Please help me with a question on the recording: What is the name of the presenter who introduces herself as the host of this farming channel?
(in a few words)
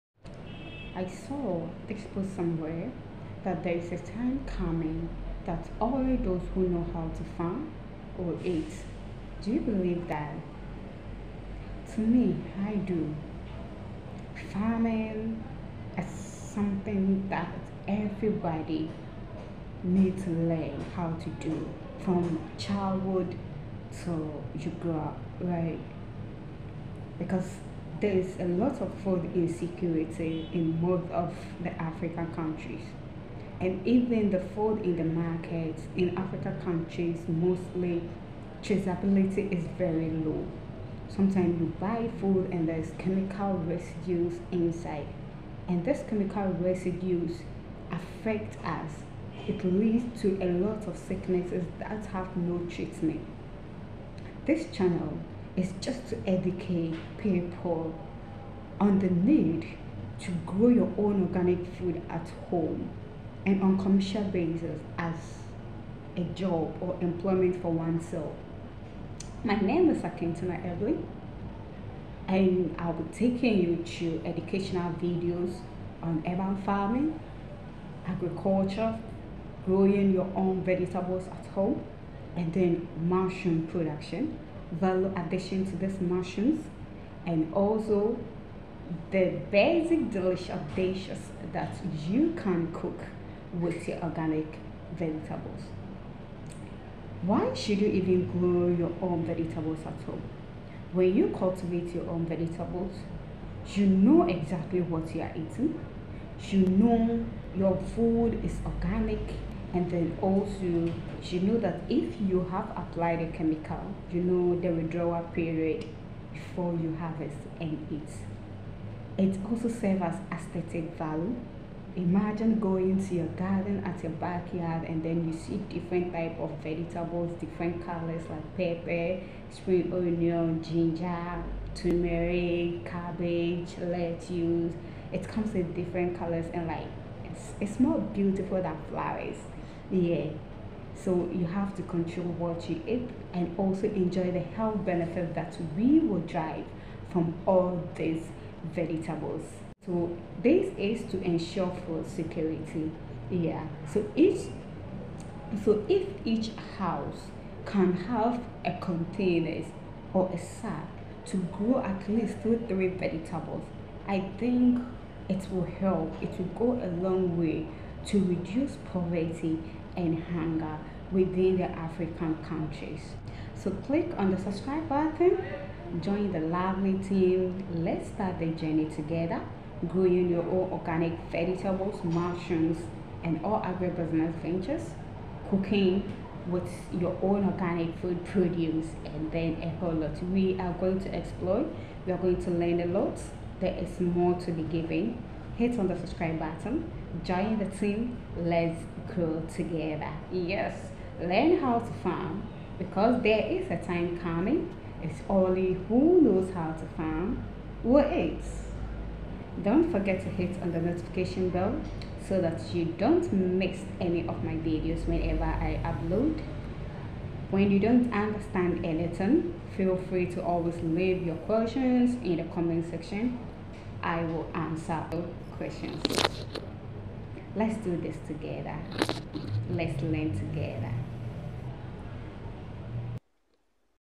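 Akintuna Evelyn.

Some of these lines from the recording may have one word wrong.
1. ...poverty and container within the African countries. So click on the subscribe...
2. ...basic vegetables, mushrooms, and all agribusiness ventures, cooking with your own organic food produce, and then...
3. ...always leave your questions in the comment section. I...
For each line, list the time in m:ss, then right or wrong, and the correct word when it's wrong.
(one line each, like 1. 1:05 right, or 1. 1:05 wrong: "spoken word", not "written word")
1. 2:48 wrong: "hunger", not "container"
2. 3:00 wrong: "organic", not "basic"
3. 3:40 right.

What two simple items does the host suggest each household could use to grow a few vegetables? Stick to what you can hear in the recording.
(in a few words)
A container or a sack.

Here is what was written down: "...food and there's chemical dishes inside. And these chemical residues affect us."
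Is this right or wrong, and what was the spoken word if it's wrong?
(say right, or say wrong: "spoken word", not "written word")
wrong: "residues", not "dishes".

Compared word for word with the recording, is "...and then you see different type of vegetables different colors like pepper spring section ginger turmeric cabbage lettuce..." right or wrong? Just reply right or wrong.
wrong.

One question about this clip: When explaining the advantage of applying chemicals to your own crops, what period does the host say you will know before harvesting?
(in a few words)
Withdrawal period.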